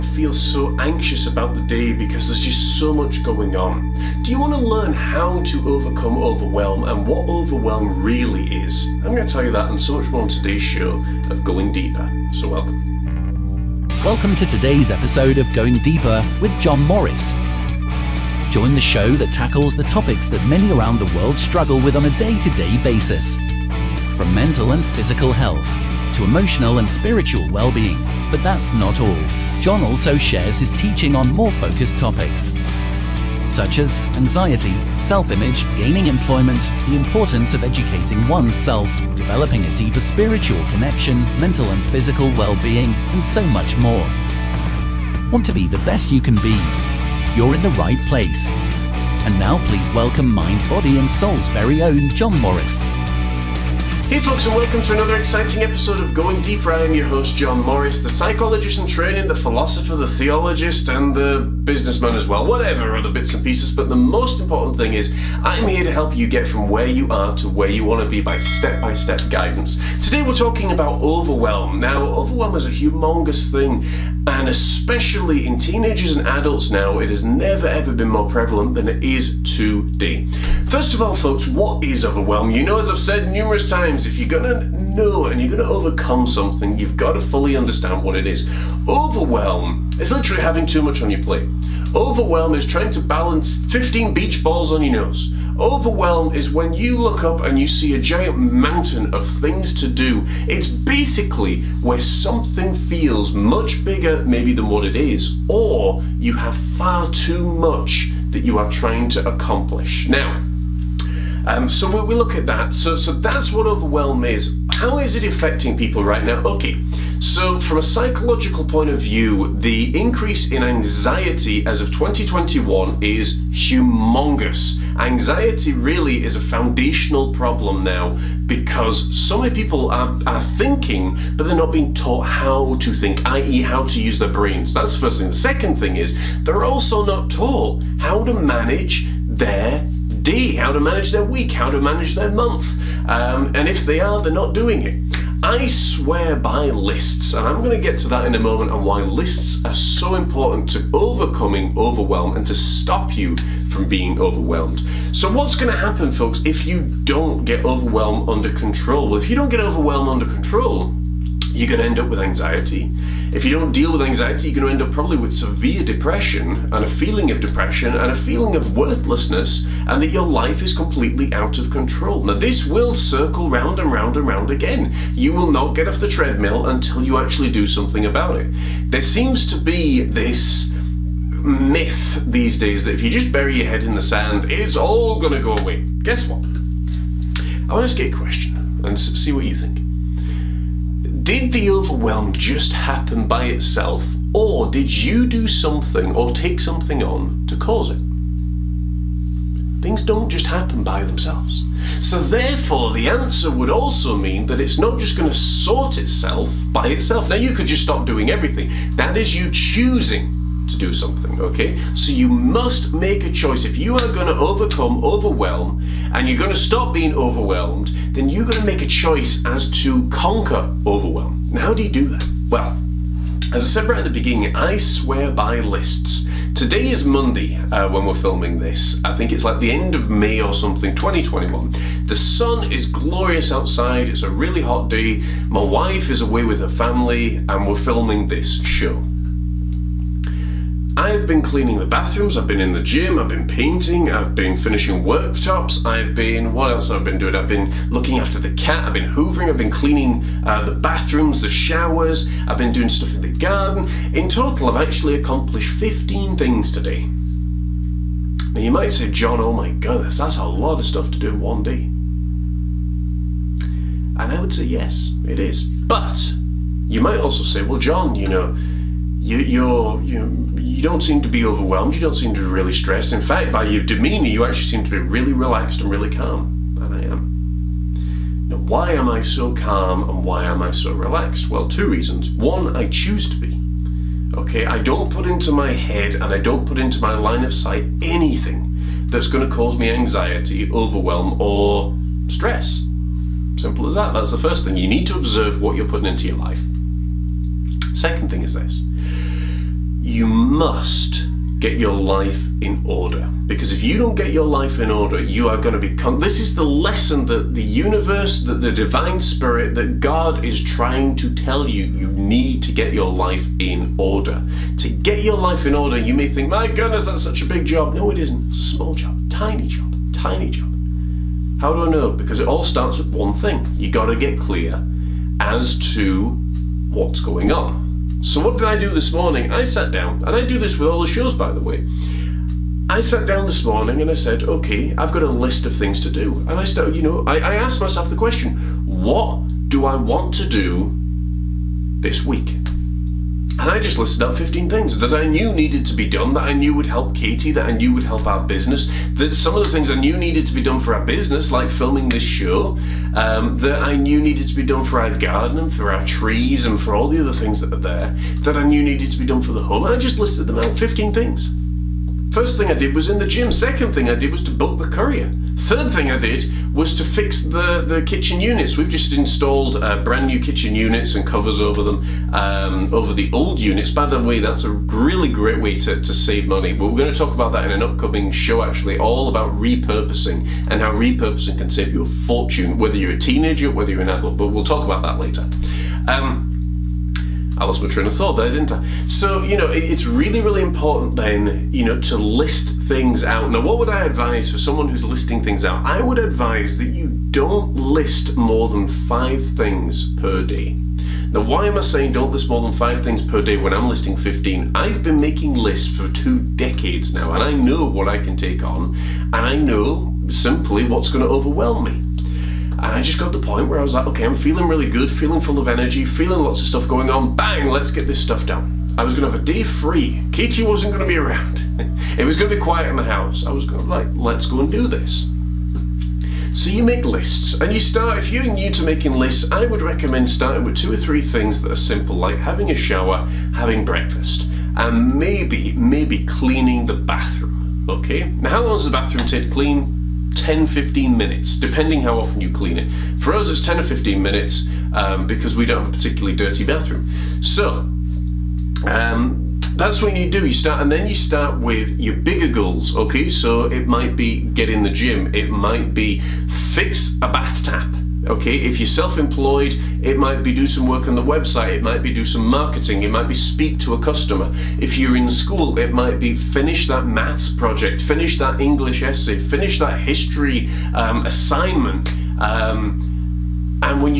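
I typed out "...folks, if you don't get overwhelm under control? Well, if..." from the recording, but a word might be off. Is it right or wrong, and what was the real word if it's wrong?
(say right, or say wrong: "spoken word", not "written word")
right.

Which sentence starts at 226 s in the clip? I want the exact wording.
Today is Monday uh, when we're filming this.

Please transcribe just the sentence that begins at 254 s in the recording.
In total, I've actually accomplished 15 things today.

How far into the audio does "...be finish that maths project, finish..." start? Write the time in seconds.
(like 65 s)
466 s.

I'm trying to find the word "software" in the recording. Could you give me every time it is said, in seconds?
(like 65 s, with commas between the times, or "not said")
not said.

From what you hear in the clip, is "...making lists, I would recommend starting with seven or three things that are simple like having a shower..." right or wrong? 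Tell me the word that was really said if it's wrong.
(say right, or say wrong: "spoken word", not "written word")
wrong: "two", not "seven".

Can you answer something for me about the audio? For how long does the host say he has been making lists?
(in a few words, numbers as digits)
Two decades.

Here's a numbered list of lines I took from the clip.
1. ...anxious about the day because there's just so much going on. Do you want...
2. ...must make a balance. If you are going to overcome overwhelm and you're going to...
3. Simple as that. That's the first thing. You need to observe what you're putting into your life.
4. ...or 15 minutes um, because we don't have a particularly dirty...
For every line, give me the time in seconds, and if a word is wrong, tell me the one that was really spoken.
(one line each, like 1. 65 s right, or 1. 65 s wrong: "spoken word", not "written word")
1. 0 s right
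2. 212 s wrong: "choice", not "balance"
3. 293 s right
4. 443 s right.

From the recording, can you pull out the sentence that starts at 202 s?
So therefore the answer would also mean that it's not just going to sort itself by itself.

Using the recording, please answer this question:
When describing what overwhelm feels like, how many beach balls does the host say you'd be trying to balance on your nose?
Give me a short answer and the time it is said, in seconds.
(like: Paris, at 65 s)
15, at 93 s.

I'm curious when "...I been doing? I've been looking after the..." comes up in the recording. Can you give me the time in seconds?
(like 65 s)
247 s.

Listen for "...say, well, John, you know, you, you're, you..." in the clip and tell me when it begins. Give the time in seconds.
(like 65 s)
267 s.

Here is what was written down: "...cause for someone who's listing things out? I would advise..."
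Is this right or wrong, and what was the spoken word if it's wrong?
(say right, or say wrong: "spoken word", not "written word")
wrong: "advise", not "cause".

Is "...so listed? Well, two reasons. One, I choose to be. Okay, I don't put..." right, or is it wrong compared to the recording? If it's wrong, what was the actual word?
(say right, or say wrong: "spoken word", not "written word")
wrong: "relaxed", not "listed".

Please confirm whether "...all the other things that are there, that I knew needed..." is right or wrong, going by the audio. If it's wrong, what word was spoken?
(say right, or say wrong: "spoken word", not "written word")
right.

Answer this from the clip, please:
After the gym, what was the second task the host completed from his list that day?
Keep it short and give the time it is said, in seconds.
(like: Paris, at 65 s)
Book the courier, at 364 s.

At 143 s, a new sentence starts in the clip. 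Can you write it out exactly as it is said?
Um, and if they are, they're not doing it.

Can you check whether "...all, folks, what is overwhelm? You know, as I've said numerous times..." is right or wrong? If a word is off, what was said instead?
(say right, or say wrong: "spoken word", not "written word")
right.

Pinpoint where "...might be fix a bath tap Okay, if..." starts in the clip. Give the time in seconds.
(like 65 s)
455 s.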